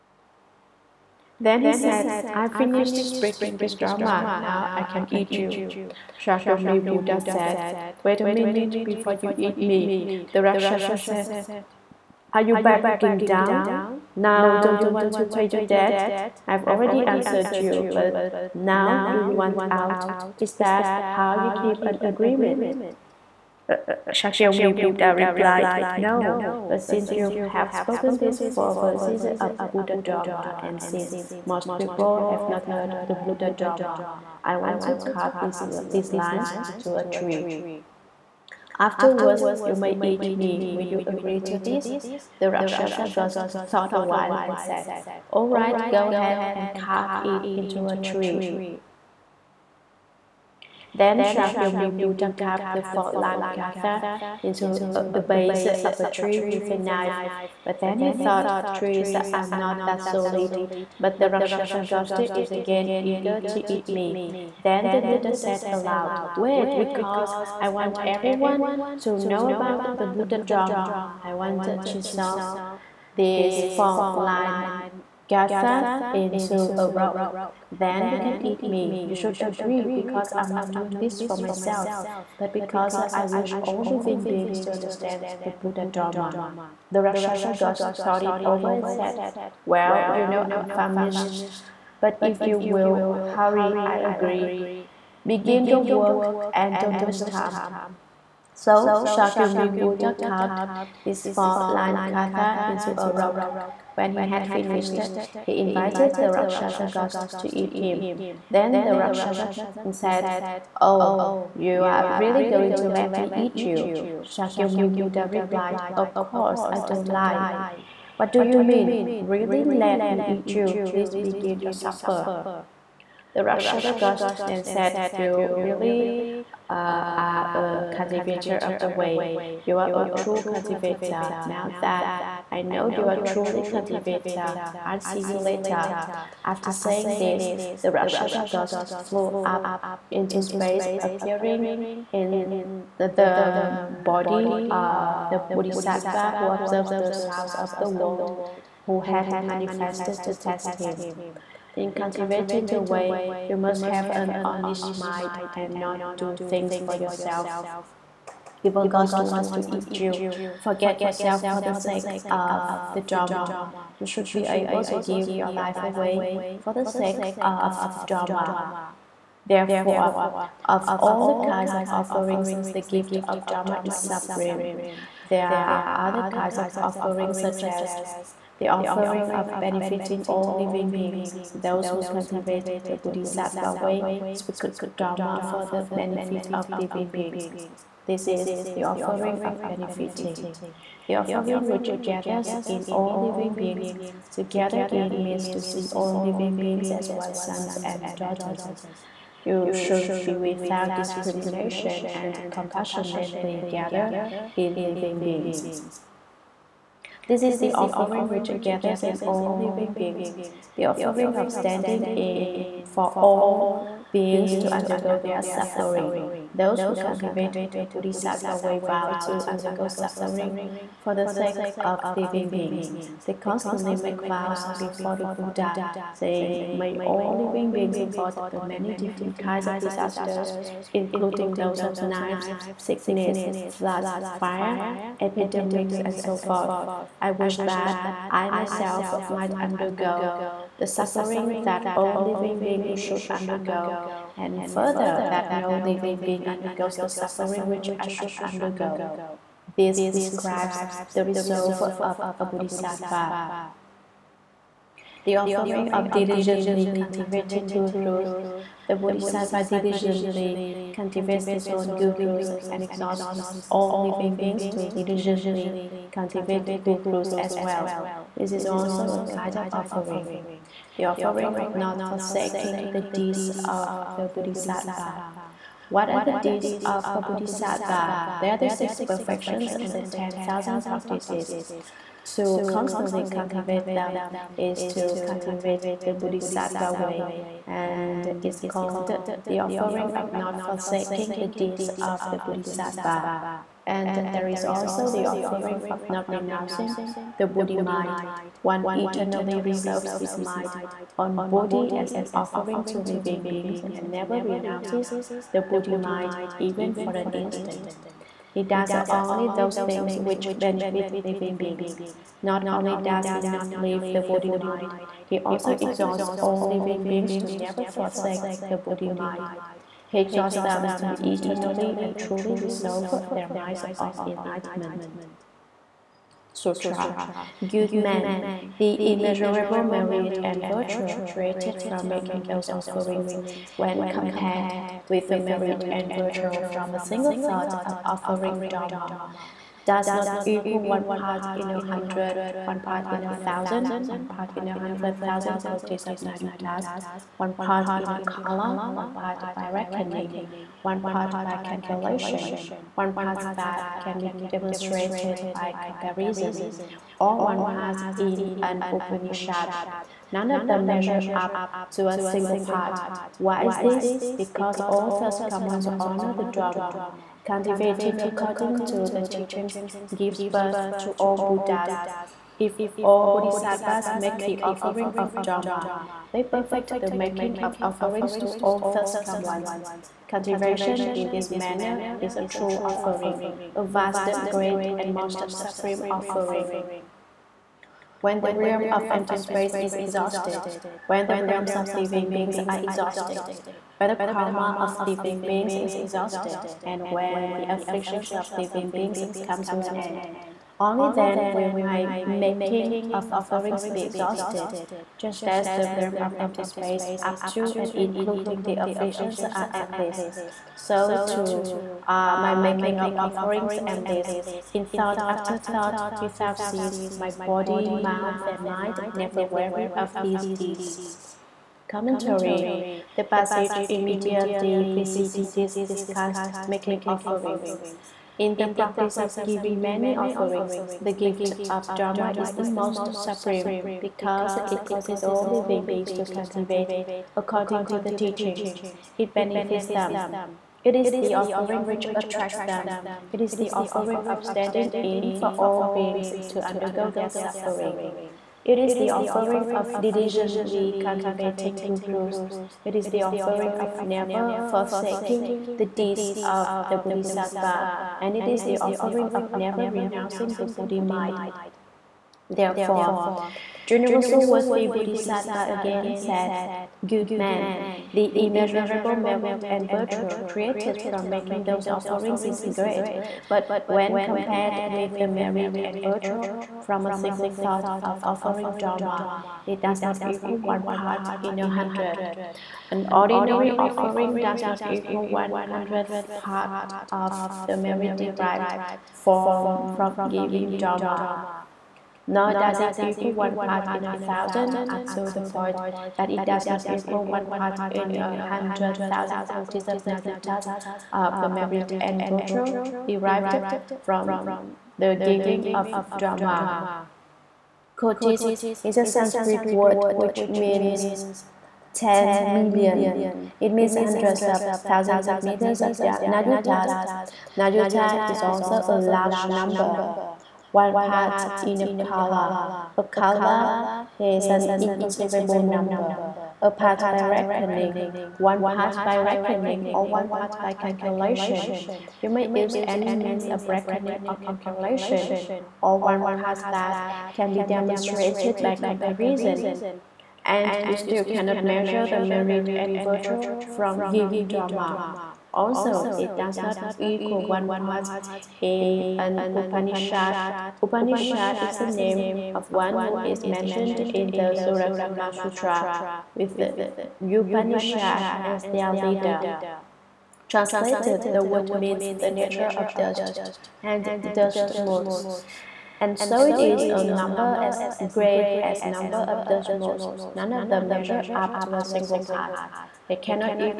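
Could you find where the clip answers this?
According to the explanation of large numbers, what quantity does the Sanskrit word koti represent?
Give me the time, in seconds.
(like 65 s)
511 s.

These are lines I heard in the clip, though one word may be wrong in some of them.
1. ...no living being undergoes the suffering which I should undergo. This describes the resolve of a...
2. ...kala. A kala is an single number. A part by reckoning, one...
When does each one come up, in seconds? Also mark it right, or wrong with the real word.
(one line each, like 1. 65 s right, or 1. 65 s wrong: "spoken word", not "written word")
1. 245 s right
2. 521 s wrong: "inconceivable", not "single".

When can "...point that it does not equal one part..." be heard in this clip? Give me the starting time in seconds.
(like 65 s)
495 s.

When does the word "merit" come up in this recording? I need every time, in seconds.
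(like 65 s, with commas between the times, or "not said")
329 s, 335 s, 469 s, 475 s, 487 s, 501 s, 542 s.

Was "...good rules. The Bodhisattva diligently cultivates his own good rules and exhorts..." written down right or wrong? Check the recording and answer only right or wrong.
right.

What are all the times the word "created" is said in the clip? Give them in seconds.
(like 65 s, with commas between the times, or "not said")
331 s, 470 s.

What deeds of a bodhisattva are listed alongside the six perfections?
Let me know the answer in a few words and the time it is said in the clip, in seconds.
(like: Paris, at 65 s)
The 10,000 practices, at 280 s.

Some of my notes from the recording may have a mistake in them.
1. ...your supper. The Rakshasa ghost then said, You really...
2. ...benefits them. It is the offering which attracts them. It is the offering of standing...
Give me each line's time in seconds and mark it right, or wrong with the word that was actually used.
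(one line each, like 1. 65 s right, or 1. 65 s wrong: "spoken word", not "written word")
1. 121 s right
2. 439 s right.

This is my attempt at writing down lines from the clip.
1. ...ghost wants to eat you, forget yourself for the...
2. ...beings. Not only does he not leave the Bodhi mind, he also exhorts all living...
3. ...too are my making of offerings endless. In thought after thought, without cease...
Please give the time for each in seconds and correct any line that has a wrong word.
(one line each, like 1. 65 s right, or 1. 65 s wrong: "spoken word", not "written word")
1. 158 s right
2. 311 s right
3. 411 s right.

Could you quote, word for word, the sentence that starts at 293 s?
And there is also the offering of not renouncing the Bodhi mind.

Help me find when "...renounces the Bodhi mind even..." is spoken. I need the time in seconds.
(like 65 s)
304 s.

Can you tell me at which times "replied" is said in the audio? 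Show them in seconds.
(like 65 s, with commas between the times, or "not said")
25 s, 115 s.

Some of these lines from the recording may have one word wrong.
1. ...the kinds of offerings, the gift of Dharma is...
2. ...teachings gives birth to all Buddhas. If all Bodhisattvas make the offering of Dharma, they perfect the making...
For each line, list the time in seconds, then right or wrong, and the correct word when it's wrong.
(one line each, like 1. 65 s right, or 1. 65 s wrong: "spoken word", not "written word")
1. 171 s right
2. 369 s right.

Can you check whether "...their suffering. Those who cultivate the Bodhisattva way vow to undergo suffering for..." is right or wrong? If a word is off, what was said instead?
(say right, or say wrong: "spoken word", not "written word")
right.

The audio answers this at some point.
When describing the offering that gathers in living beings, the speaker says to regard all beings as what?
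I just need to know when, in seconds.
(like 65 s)
197 s.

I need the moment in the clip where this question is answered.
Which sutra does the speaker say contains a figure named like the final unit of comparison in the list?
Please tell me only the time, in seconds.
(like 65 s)
554 s.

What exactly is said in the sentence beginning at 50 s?
Then Shakyamuni Buddha carved the four line gatha into uh, the base of a tree with a knife.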